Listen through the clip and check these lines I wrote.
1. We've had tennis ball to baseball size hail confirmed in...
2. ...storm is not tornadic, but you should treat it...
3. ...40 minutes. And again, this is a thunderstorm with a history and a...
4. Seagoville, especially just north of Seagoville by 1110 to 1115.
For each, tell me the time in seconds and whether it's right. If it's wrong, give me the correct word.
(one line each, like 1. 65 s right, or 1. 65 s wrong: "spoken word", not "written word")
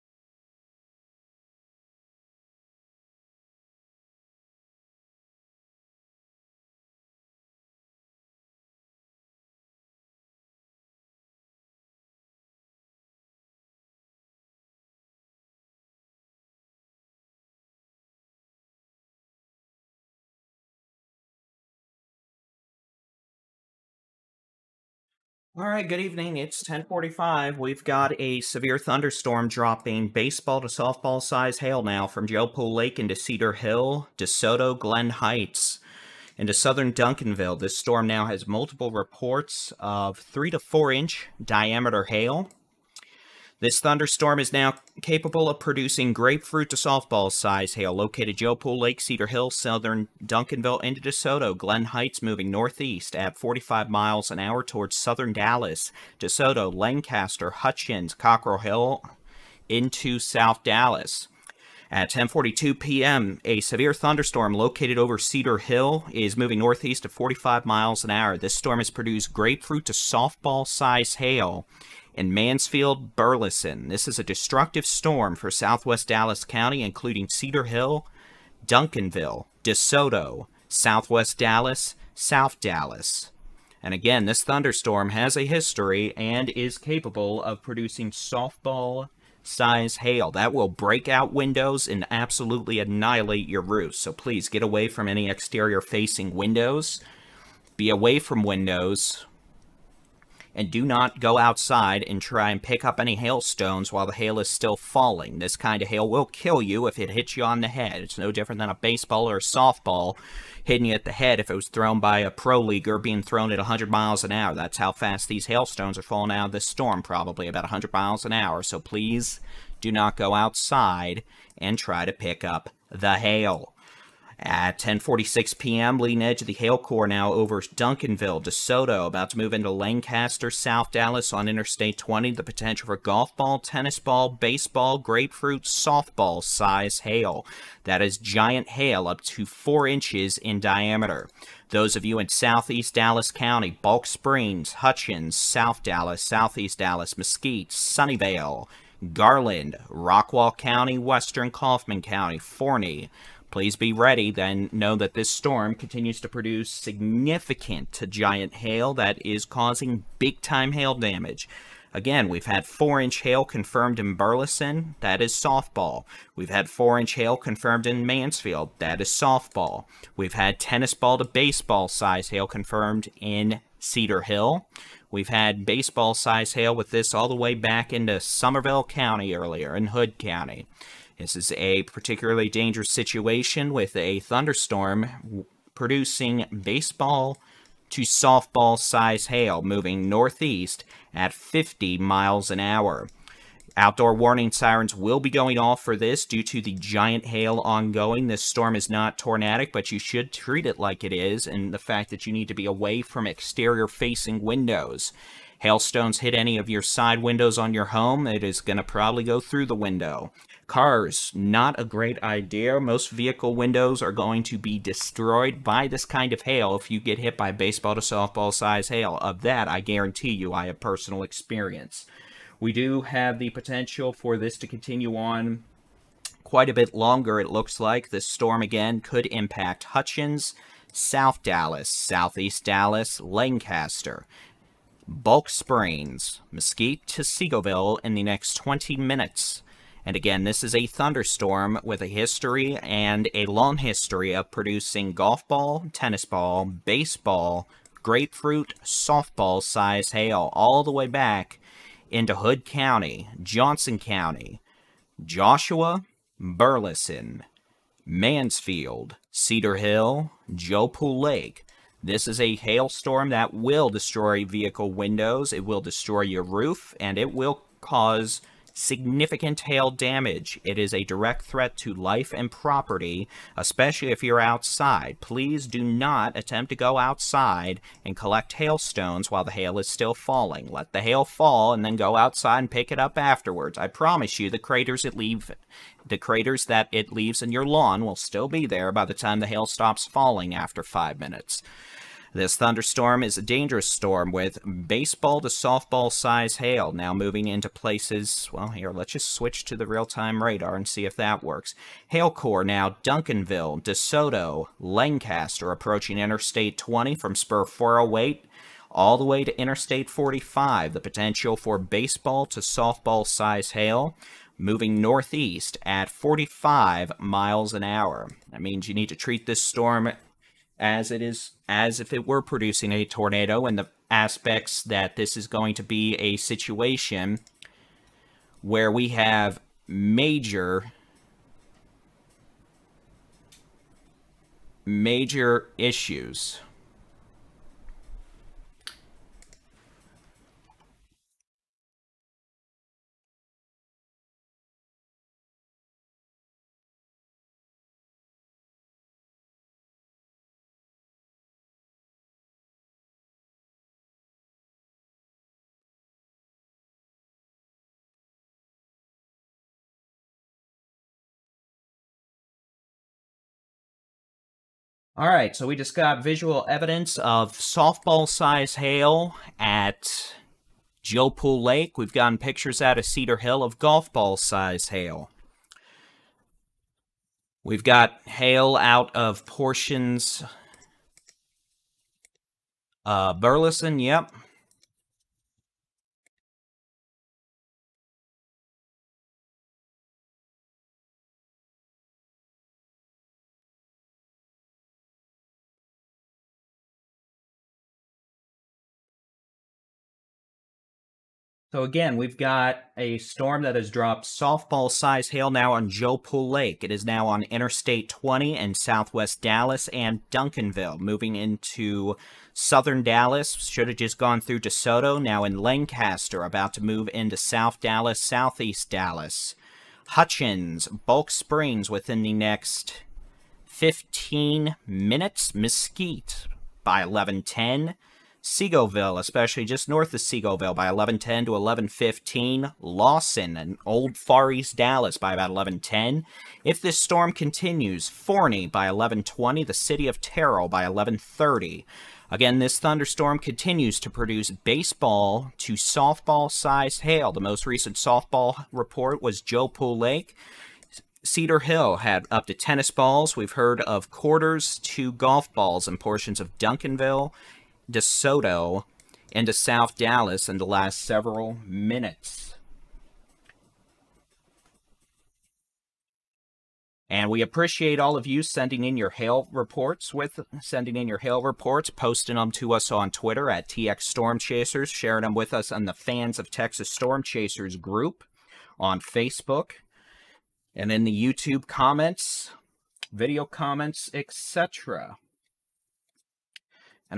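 1. 170 s right
2. 198 s right
3. 238 s wrong: "20", not "40"
4. 428 s right.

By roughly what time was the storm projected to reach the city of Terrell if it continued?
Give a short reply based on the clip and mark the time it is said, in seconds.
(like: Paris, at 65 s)
11:30, at 439 s.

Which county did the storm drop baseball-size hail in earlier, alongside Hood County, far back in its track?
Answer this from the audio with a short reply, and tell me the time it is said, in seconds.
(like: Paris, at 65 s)
Somervell County, at 178 s.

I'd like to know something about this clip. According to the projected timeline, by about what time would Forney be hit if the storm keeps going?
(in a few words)
11:20.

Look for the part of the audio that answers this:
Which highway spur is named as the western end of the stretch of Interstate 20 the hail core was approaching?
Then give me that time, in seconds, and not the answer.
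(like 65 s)
307 s.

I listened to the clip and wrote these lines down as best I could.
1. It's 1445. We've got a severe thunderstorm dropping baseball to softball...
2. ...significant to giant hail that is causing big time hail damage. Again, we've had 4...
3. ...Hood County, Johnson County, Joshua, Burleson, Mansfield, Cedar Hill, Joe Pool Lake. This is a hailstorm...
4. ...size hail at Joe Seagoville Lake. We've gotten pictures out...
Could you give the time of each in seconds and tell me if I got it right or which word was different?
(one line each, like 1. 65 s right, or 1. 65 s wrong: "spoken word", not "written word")
1. 26 s wrong: "1045", not "1445"
2. 156 s right
3. 252 s right
4. 368 s wrong: "Pool", not "Seagoville".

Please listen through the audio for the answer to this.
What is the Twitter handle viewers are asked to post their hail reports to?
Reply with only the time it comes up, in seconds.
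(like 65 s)
473 s.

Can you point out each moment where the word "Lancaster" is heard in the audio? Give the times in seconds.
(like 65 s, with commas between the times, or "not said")
56 s, 129 s, 233 s, 304 s, 415 s.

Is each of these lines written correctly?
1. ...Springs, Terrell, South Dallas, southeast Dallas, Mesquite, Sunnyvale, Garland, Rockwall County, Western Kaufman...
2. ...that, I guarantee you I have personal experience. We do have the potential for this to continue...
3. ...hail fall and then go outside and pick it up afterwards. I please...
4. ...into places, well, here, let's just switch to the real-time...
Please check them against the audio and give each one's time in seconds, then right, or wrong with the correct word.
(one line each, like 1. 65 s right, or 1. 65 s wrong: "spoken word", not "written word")
1. 144 s wrong: "Hutchins", not "Terrell"
2. 219 s right
3. 281 s wrong: "promise", not "please"
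4. 297 s right.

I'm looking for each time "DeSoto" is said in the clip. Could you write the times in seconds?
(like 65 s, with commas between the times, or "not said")
34 s, 50 s, 56 s, 79 s, 128 s, 303 s, 414 s, 457 s.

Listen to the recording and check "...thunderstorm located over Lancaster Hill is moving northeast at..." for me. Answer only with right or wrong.
wrong.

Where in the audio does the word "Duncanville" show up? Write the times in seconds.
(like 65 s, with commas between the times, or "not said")
36 s, 50 s, 78 s, 127 s, 303 s, 410 s, 456 s.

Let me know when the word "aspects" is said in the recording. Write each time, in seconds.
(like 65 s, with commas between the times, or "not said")
324 s.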